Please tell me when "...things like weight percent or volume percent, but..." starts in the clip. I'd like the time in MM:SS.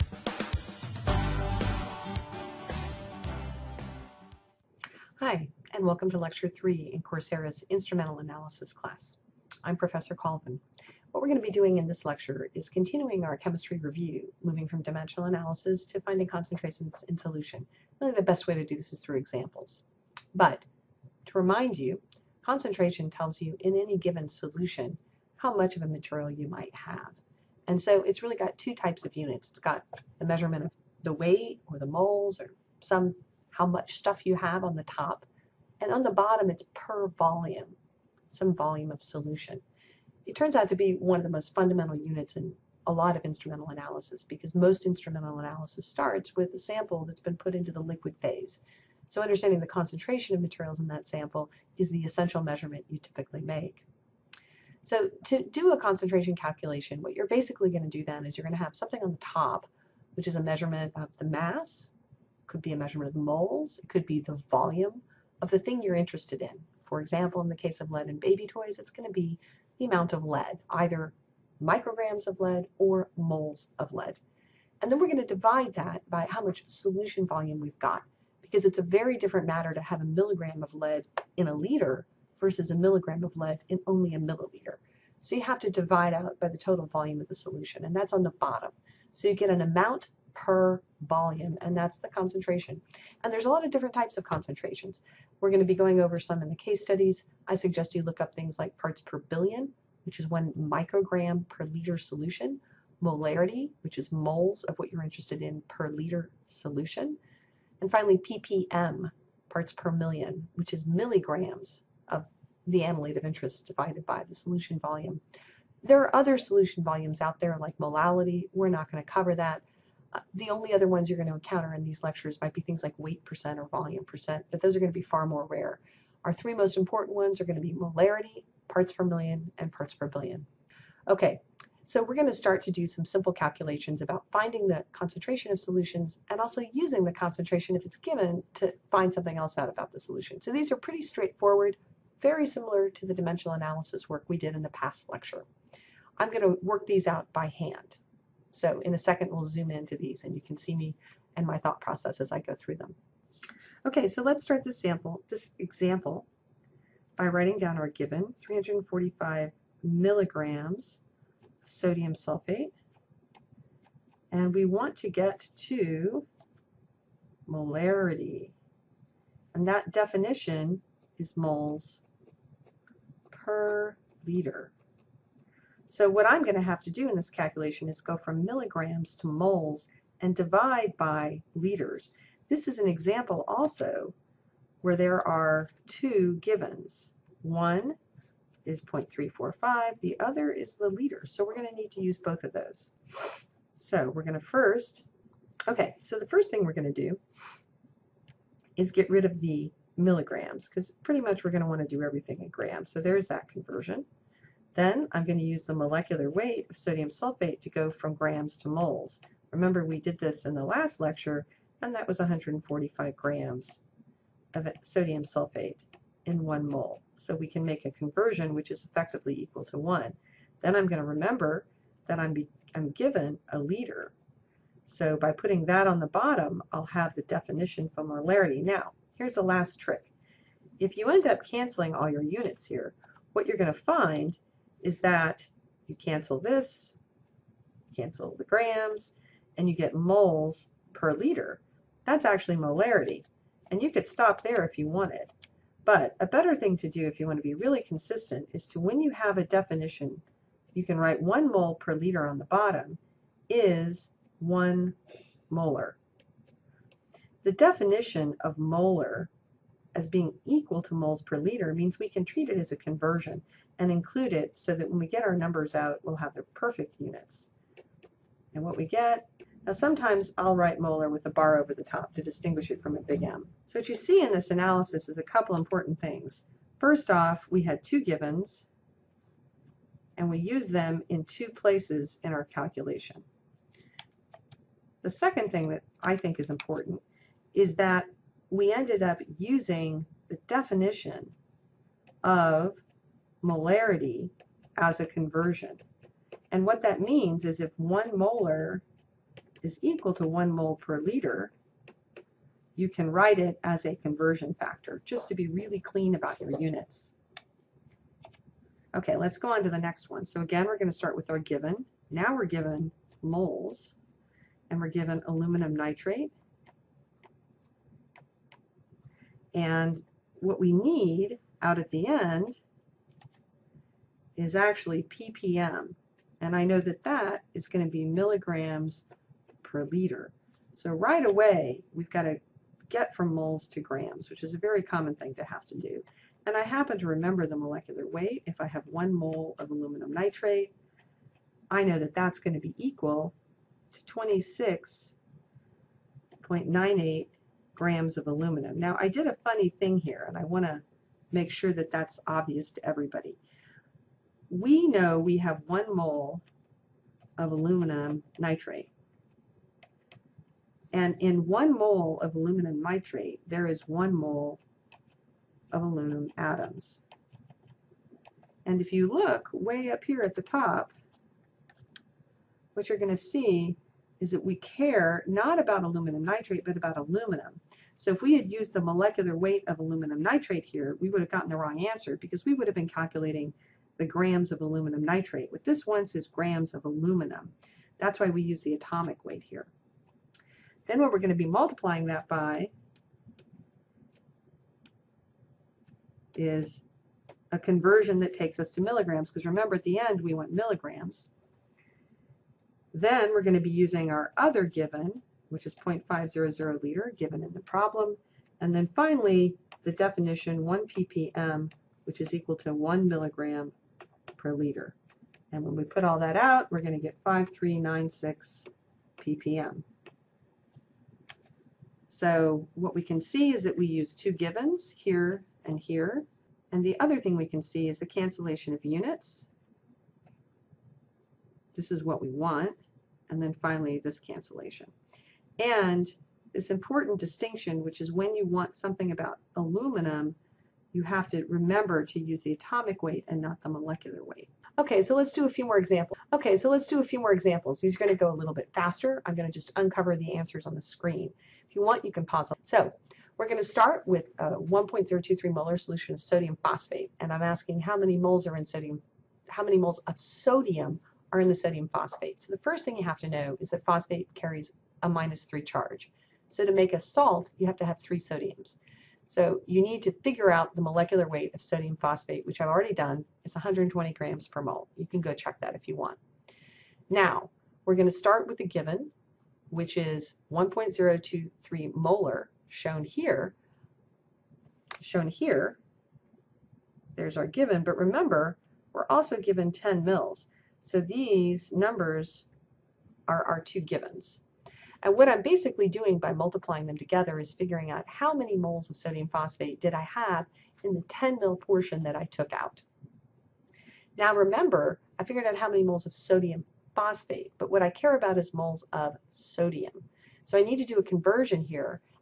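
02:02.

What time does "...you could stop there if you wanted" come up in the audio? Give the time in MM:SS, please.
04:03.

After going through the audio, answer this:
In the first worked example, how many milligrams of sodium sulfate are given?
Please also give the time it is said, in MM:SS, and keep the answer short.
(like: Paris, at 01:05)
345 milligrams, at 02:38.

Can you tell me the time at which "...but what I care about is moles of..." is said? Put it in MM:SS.
08:27.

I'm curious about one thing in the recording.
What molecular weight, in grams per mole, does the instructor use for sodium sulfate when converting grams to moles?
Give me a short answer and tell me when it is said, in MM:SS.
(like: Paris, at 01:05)
145 grams, at 03:32.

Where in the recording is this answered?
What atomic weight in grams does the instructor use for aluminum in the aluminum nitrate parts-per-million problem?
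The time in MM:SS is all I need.
05:44.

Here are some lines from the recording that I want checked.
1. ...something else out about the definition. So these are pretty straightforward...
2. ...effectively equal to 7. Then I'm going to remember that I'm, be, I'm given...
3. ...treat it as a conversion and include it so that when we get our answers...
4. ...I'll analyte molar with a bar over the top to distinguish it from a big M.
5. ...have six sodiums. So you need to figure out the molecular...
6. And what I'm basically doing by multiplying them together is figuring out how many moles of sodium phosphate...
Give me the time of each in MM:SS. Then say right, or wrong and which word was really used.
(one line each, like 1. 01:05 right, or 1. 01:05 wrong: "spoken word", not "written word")
1. 02:19 wrong: "solution", not "definition"
2. 03:38 wrong: "1", not "7"
3. 04:22 wrong: "numbers", not "answers"
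4. 04:30 wrong: "write", not "analyte"
5. 07:47 wrong: "three", not "six"
6. 08:15 right.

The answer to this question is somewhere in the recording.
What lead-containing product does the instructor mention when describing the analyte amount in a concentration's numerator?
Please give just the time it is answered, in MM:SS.
01:08.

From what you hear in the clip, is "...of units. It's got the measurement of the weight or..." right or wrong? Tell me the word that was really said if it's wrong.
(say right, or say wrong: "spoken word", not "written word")
right.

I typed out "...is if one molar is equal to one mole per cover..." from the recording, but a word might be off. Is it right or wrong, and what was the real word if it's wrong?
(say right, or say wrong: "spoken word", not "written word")
wrong: "liter", not "cover".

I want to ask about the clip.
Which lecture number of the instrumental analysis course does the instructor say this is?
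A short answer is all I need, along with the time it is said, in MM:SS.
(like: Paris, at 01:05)
3, at 00:06.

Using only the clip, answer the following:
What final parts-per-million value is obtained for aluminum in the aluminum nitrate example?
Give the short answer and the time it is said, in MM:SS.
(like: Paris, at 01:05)
5396 ppm, at 06:57.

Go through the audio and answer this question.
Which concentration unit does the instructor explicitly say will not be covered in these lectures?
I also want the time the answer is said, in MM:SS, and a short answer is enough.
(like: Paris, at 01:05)
molality, at 01:57.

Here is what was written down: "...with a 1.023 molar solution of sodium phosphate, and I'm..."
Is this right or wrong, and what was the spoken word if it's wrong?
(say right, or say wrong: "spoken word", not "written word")
right.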